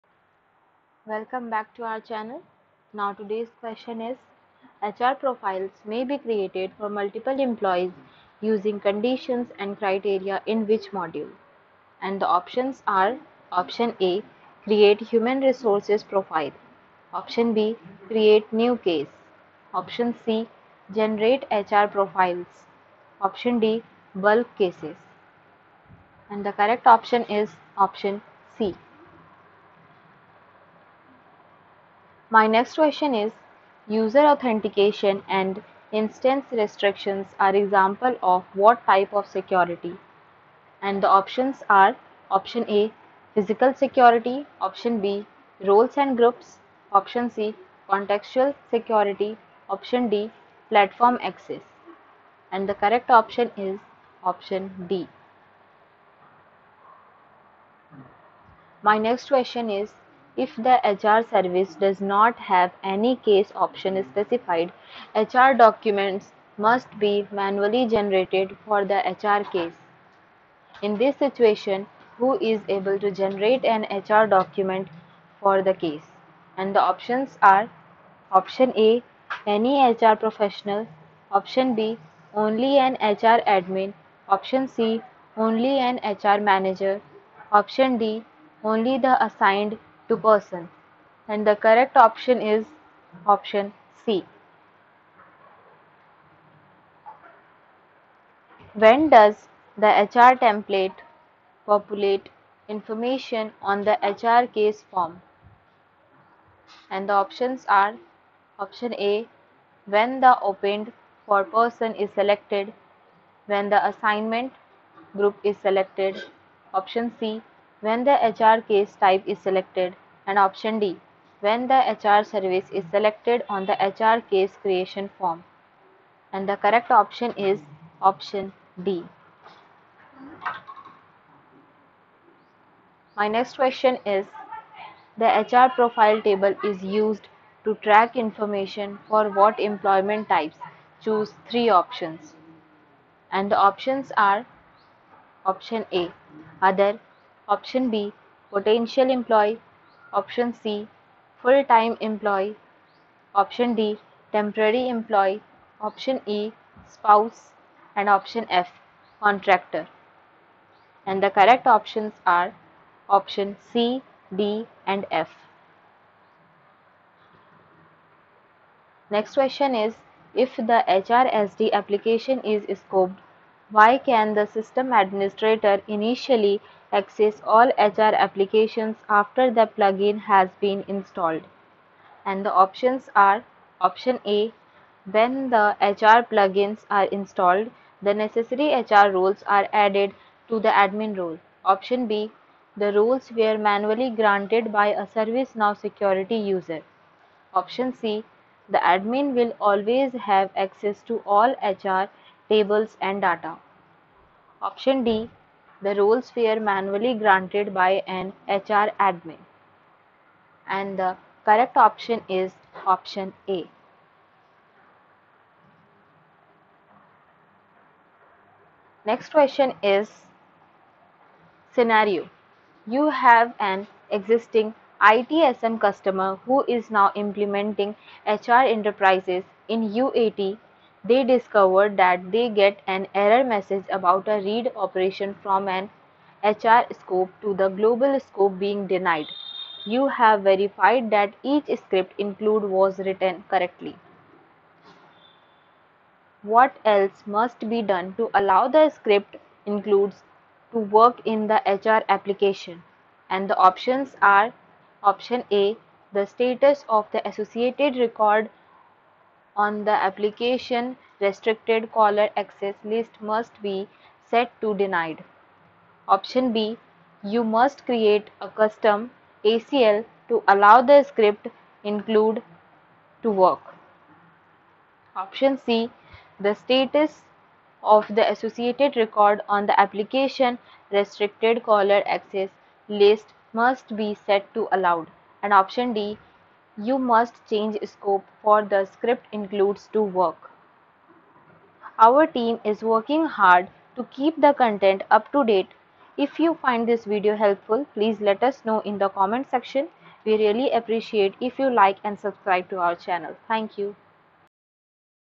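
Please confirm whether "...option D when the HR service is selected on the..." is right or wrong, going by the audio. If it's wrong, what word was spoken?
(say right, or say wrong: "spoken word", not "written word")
right.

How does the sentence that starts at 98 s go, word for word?
When does the HR template populate information on the HR case form?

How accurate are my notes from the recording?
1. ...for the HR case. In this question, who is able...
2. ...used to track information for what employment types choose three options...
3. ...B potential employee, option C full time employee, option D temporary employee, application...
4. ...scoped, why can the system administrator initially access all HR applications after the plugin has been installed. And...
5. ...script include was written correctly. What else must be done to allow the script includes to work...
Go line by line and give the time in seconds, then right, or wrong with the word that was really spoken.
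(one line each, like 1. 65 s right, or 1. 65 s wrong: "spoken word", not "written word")
1. 68 s wrong: "situation", not "question"
2. 136 s right
3. 147 s wrong: "option", not "application"
4. 172 s right
5. 241 s right.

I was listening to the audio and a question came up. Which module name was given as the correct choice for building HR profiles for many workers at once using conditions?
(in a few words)
Generate HR profiles.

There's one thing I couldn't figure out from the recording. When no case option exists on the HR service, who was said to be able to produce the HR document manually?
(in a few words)
Only an HR manager.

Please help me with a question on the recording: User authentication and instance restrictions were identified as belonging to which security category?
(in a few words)
Platform access.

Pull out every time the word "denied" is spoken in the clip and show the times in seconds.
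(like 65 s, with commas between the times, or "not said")
238 s, 264 s.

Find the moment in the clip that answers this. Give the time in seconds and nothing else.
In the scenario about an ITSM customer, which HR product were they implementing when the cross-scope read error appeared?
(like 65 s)
228 s.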